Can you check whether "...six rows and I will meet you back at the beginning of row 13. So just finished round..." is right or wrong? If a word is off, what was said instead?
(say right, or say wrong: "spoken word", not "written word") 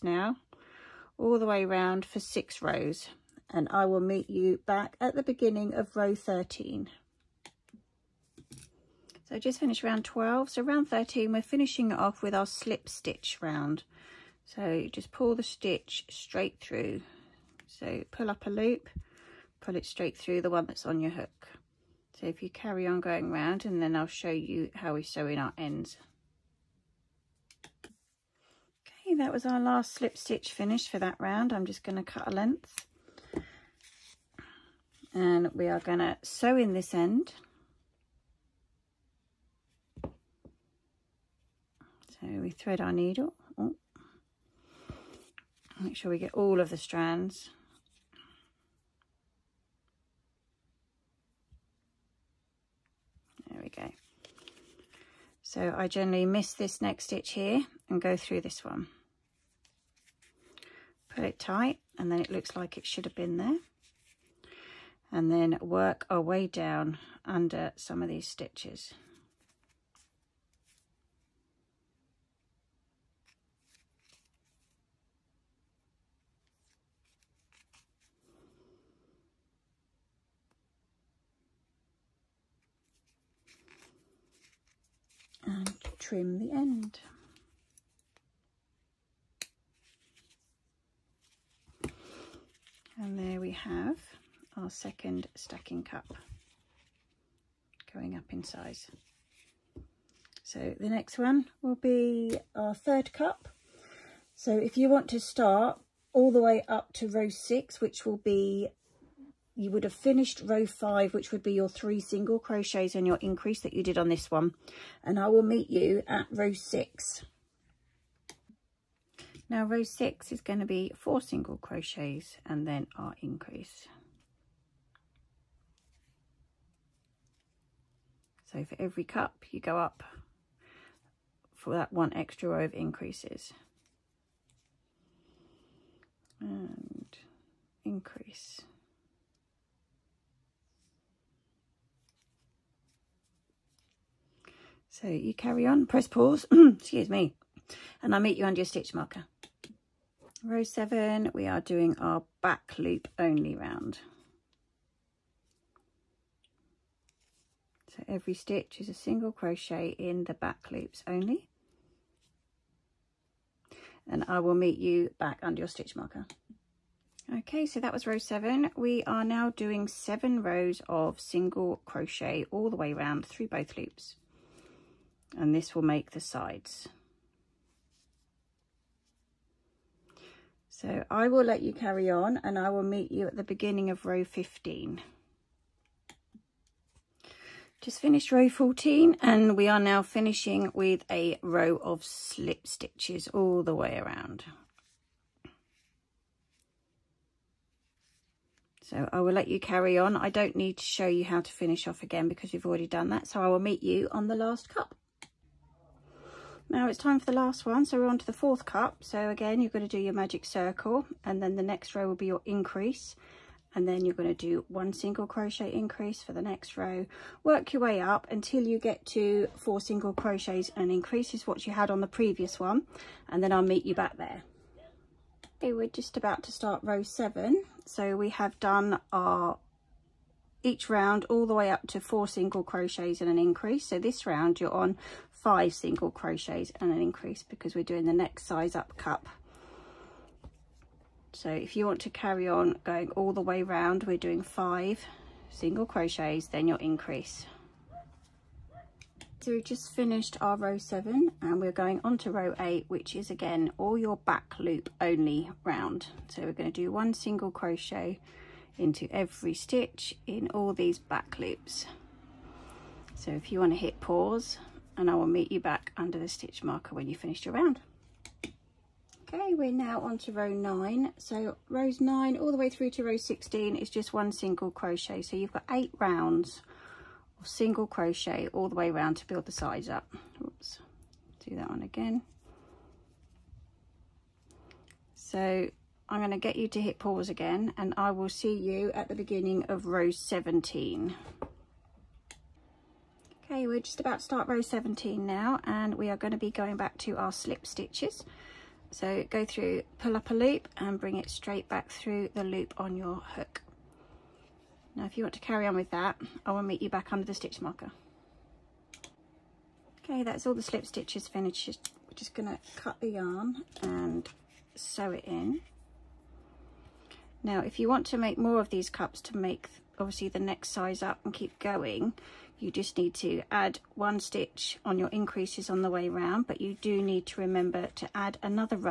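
right.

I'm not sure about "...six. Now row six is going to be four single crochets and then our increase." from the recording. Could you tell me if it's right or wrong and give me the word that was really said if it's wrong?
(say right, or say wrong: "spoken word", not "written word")
right.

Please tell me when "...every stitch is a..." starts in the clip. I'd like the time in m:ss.
2:38.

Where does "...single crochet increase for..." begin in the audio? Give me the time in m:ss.
3:34.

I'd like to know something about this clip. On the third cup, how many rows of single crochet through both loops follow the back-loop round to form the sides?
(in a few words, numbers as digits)
7.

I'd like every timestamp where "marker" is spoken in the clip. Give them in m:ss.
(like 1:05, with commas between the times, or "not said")
2:28, 2:45, 4:26, 5:07.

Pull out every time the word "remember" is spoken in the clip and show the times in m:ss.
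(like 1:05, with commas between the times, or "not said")
5:27.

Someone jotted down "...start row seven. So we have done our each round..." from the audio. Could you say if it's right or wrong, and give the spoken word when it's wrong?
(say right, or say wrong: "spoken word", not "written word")
right.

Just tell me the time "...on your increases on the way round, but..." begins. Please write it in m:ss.
5:24.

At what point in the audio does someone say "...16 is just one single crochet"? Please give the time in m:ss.
4:33.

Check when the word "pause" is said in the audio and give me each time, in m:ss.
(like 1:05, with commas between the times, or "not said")
2:26, 4:23, 4:46.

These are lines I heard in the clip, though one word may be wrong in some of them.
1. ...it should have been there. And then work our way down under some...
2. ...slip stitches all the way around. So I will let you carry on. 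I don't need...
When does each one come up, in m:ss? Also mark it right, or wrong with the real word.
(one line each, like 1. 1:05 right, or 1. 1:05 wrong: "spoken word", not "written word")
1. 1:02 right
2. 3:12 right.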